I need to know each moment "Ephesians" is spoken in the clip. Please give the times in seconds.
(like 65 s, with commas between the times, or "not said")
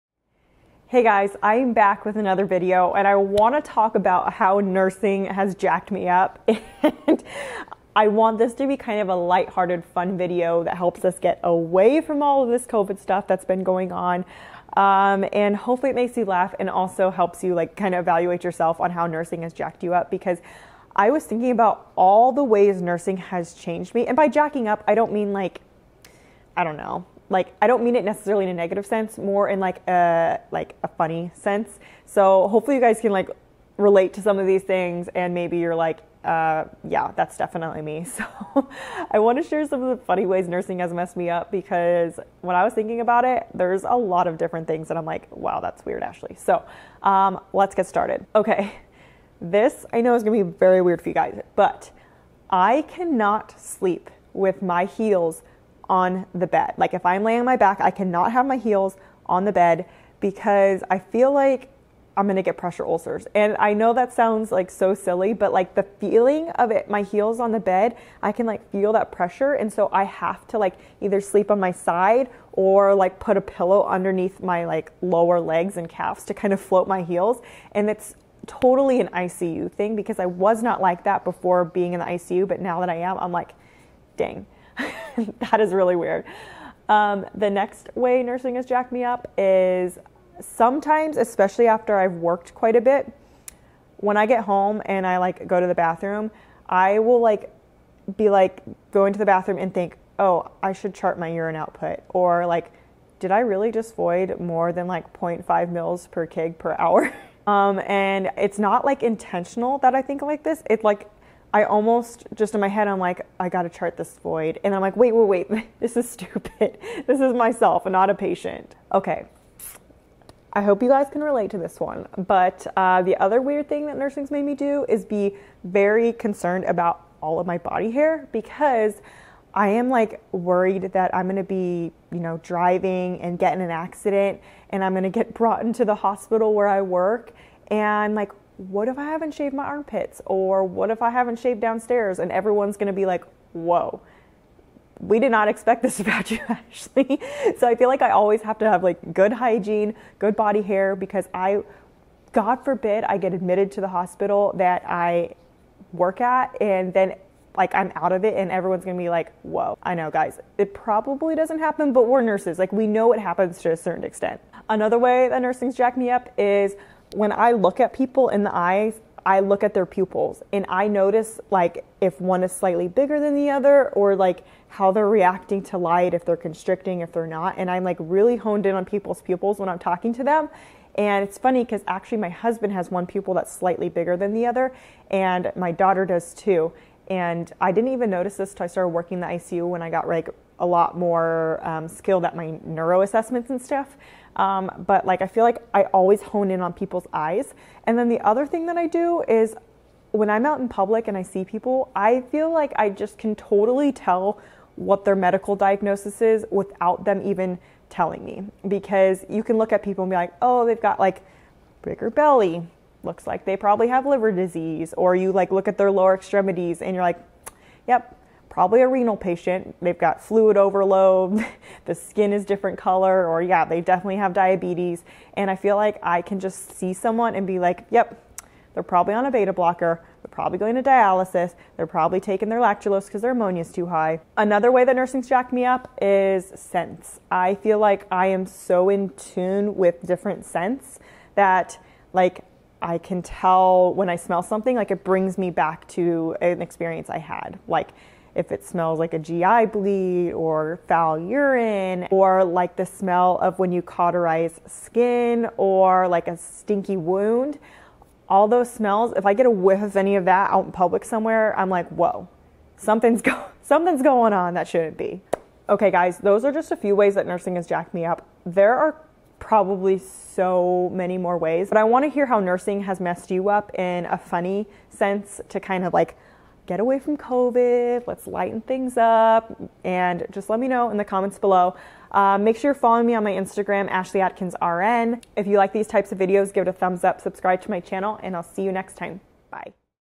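not said.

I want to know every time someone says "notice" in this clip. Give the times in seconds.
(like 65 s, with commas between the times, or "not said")
170 s, 188 s.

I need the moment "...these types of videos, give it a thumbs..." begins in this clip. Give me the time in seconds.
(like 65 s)
285 s.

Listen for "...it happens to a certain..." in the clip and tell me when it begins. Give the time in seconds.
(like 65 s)
163 s.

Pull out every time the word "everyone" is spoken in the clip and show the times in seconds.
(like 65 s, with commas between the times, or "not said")
142 s, 158 s.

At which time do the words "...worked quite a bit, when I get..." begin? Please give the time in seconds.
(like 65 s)
92 s.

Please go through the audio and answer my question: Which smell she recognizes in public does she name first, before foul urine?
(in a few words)
GI bleed.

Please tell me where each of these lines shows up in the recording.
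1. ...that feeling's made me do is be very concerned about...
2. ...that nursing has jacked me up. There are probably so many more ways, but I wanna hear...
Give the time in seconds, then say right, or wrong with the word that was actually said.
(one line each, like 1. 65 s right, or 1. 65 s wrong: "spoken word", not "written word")
1. 123 s wrong: "nursing", not "feeling"
2. 267 s right.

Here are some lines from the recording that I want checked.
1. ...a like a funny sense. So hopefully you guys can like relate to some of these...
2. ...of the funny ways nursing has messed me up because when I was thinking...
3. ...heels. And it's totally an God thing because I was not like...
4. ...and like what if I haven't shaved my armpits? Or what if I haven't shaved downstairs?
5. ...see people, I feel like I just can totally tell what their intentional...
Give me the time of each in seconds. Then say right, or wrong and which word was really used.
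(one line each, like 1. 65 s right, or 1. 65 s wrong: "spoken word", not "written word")
1. 29 s right
2. 39 s right
3. 77 s wrong: "ICU", not "God"
4. 137 s right
5. 201 s wrong: "medical", not "intentional".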